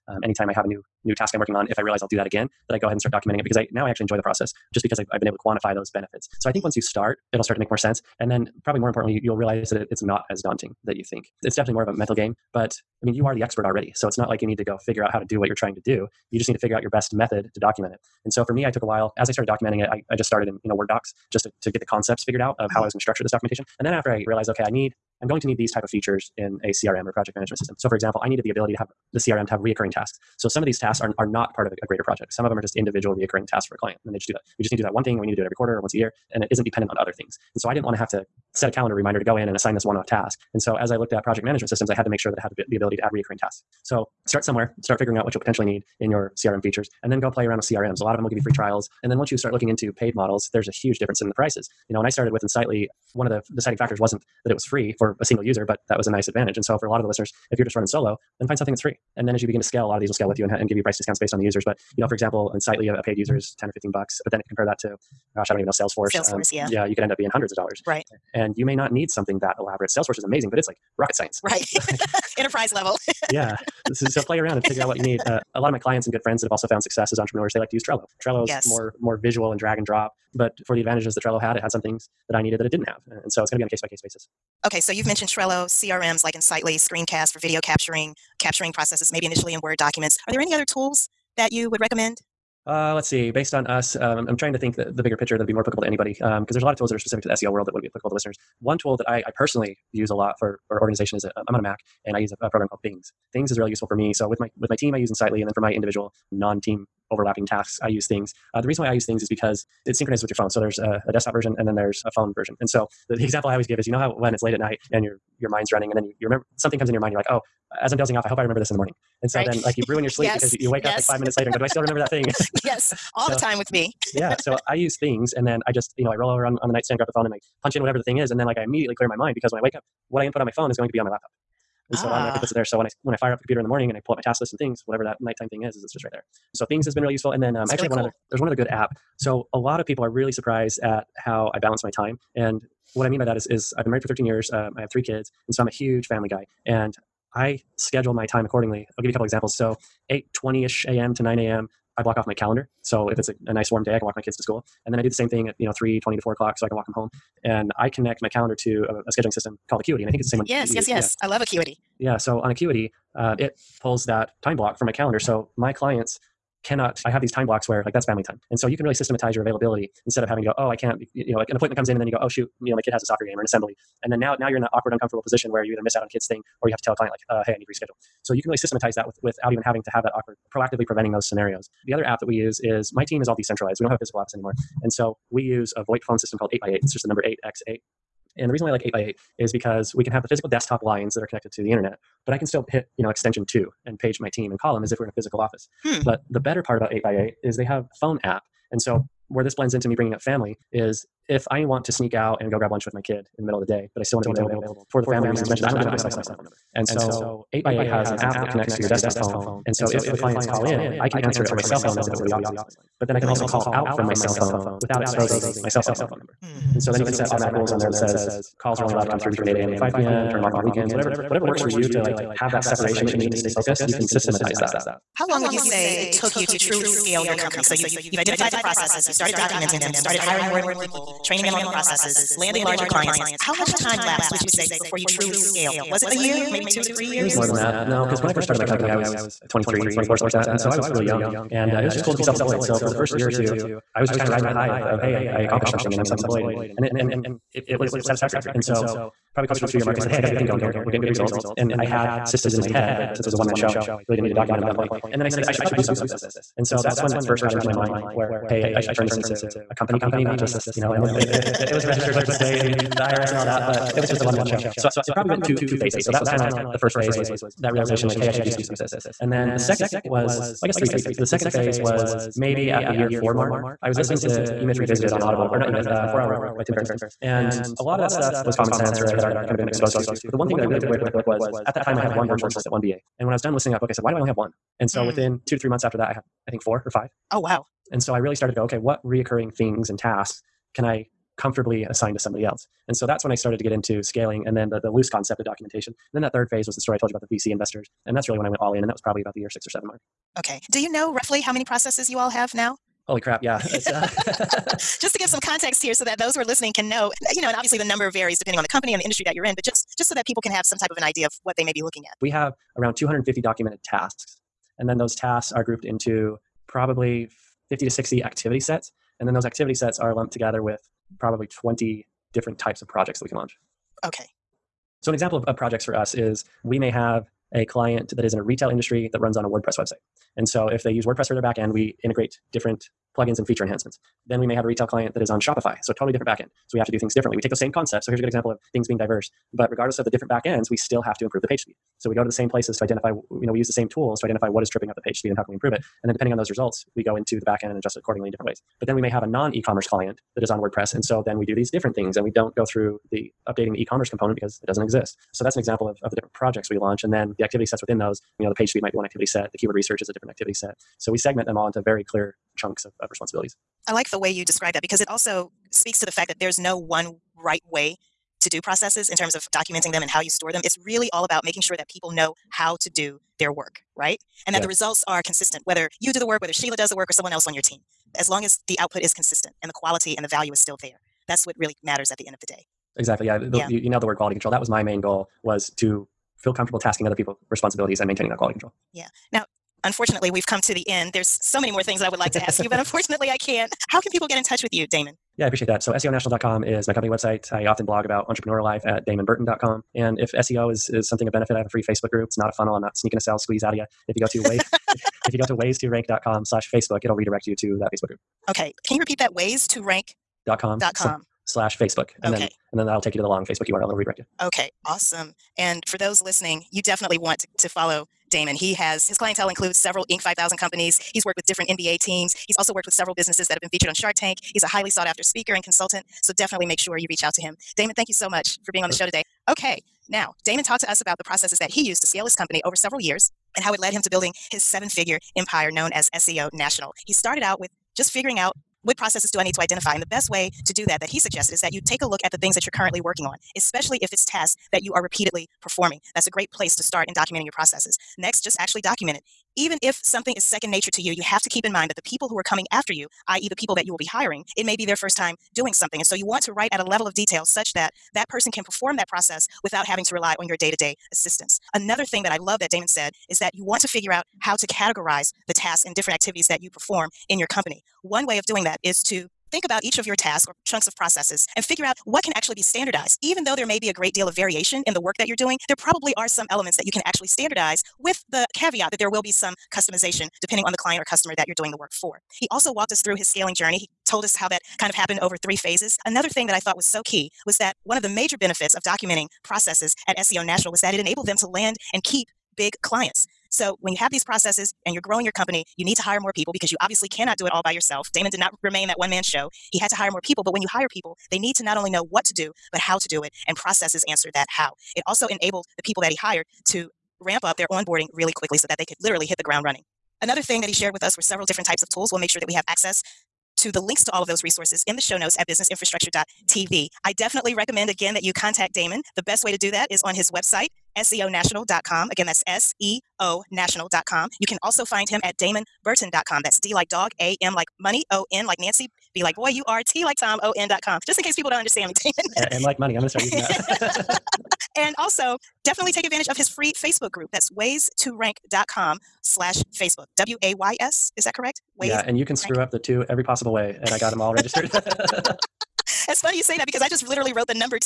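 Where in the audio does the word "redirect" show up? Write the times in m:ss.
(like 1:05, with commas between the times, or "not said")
6:47, 6:53.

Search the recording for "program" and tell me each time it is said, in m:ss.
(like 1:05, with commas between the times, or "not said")
1:42.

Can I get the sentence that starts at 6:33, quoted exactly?
How can people get in touch with you, Damon?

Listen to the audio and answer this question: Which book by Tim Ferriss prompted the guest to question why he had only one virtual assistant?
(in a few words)
Four Hour Work Week.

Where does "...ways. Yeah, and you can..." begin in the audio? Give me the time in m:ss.
9:01.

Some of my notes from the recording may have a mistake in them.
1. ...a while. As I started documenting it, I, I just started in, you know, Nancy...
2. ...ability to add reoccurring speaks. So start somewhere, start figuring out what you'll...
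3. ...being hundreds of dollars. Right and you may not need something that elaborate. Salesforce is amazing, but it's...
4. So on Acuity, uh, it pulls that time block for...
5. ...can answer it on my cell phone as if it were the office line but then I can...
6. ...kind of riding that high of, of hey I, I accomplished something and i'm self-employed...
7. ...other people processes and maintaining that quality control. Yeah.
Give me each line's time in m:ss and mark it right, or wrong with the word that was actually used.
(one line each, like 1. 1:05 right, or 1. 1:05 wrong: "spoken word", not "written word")
1. 0:18 wrong: "Word", not "Nancy"
2. 0:42 wrong: "tasks", not "speaks"
3. 1:07 right
4. 2:42 right
5. 3:31 right
6. 4:04 right
7. 6:27 wrong: "responsibilities", not "processes".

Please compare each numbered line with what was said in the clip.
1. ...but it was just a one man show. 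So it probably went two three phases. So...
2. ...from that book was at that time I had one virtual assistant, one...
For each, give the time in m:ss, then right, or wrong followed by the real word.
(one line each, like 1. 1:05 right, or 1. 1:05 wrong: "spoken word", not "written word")
1. 4:23 wrong: "two", not "three"
2. 4:40 right.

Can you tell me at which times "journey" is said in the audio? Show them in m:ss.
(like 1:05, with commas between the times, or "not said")
8:03.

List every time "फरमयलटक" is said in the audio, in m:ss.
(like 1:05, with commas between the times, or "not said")
not said.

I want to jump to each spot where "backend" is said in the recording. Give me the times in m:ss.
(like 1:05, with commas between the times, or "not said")
5:31, 5:36, 5:40, 5:47.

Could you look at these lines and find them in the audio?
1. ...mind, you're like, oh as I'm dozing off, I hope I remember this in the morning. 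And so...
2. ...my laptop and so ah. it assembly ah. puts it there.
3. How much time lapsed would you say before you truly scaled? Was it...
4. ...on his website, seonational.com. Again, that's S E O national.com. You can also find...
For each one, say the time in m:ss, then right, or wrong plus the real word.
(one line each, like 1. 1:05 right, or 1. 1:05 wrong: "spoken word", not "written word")
1. 1:56 right
2. 2:11 wrong: "automatically", not "assembly"
3. 3:53 right
4. 8:40 right.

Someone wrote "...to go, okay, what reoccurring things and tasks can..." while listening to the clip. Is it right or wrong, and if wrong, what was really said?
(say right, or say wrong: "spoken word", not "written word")
right.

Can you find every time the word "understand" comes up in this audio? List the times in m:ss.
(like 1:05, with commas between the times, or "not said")
8:51.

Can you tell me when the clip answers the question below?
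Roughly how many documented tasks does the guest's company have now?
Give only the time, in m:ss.
5:12.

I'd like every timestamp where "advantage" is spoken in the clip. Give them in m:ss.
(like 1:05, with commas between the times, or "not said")
0:56, 1:20, 8:56.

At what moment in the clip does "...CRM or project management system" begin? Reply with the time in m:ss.
0:26.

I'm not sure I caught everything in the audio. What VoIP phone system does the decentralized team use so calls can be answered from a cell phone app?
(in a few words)
8x8.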